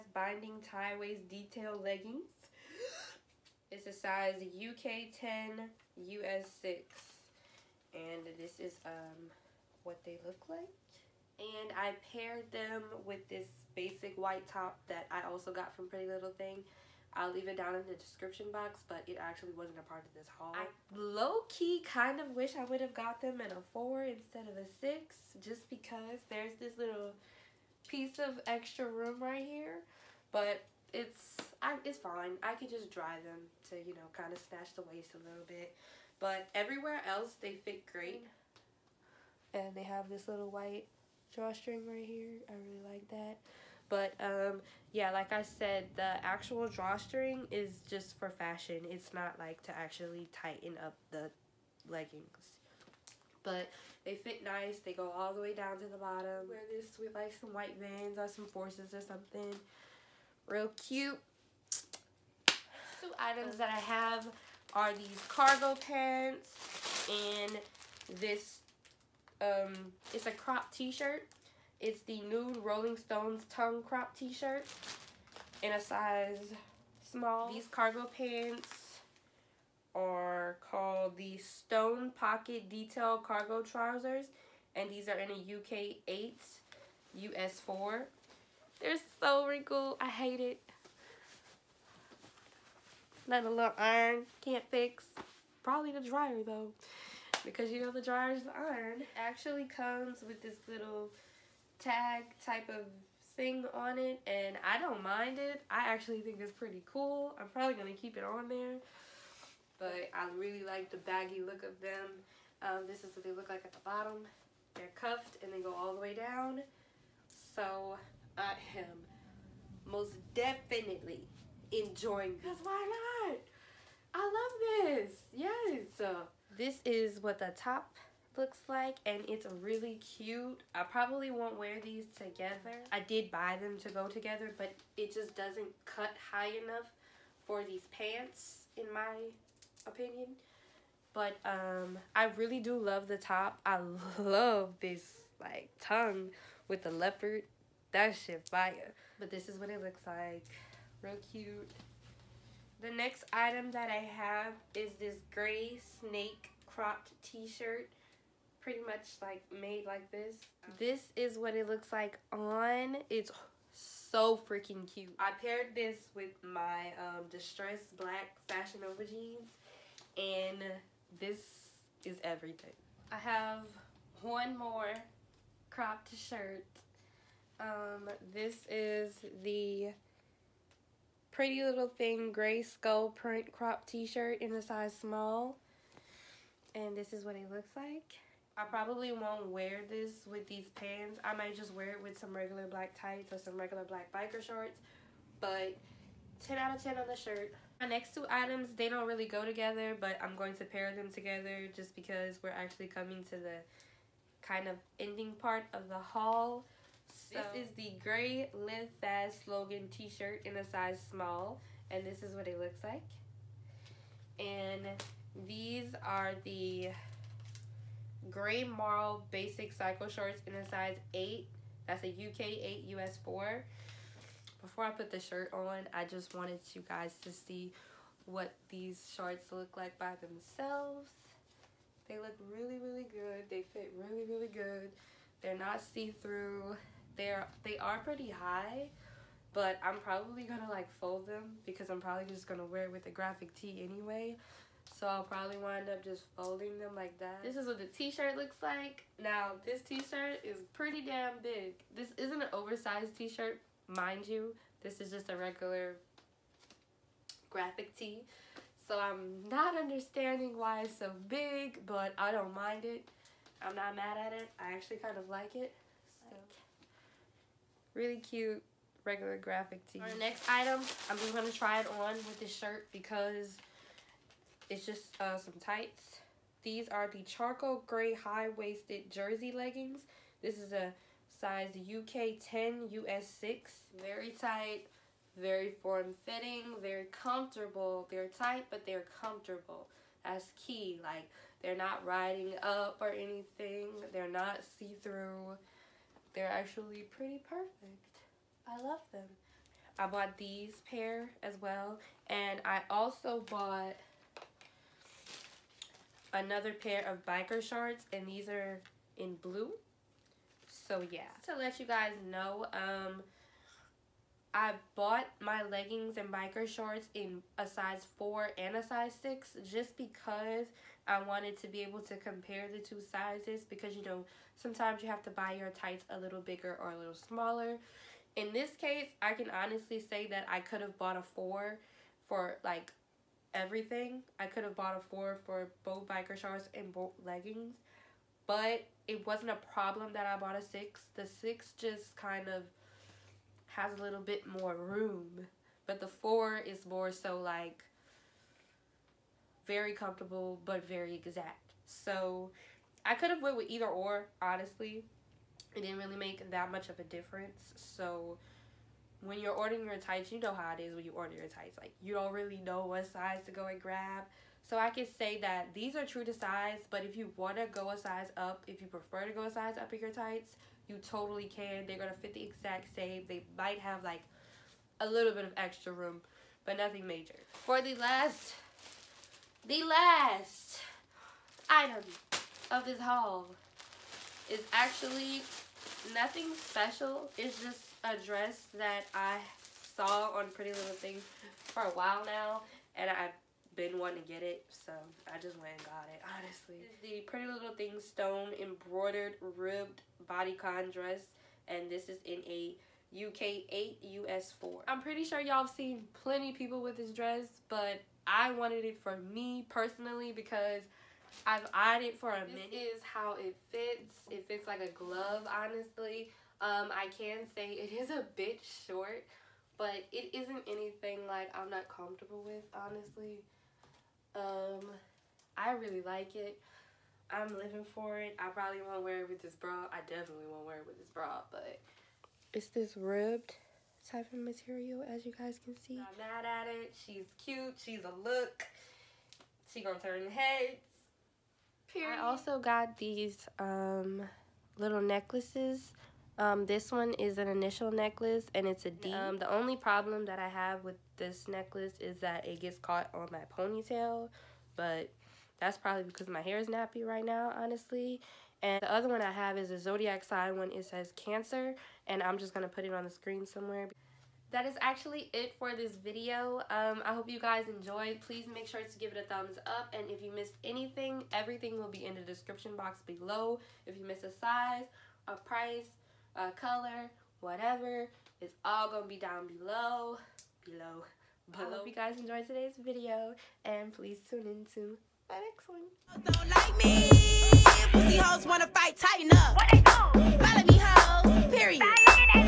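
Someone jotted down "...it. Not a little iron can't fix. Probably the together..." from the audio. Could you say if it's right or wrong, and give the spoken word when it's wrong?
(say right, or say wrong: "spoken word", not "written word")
wrong: "dryer", not "together".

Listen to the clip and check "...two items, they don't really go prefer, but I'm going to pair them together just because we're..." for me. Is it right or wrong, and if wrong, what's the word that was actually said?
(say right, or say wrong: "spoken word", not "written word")
wrong: "together", not "prefer".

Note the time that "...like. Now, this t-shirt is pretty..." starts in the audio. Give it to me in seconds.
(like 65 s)
248 s.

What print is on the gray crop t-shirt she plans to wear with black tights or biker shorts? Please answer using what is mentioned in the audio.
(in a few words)
Skull.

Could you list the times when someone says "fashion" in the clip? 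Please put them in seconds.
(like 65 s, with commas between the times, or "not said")
48 s, 168 s.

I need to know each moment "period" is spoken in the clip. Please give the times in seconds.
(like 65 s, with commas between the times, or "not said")
441 s, 491 s.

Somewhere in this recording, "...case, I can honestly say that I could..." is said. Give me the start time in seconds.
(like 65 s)
328 s.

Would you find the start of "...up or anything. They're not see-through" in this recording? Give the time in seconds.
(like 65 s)
292 s.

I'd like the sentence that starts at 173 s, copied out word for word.
I have one more cropped shirt.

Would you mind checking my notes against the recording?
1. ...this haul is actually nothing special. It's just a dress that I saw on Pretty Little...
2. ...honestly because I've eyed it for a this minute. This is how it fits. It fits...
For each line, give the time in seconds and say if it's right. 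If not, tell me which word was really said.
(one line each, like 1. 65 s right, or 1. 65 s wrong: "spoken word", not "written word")
1. 382 s right
2. 409 s wrong: "personally", not "honestly".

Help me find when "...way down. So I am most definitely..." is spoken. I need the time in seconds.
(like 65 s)
116 s.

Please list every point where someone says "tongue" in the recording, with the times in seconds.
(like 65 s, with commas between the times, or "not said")
73 s, 145 s.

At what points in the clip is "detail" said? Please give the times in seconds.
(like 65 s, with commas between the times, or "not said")
1 s, 82 s.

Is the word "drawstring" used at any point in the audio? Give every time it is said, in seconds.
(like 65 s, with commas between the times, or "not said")
41 s, 46 s.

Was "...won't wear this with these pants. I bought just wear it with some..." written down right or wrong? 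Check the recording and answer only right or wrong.
wrong.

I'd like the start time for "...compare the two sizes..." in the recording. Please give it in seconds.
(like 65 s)
322 s.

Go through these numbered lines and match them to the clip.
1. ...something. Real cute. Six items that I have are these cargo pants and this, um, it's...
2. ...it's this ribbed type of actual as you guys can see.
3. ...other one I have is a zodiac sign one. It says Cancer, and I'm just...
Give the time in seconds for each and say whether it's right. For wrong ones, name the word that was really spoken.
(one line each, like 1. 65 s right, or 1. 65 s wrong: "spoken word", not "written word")
1. 59 s wrong: "Two", not "Six"
2. 432 s wrong: "material", not "actual"
3. 458 s right.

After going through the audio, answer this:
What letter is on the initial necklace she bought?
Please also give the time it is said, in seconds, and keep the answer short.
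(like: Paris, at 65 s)
D, at 448 s.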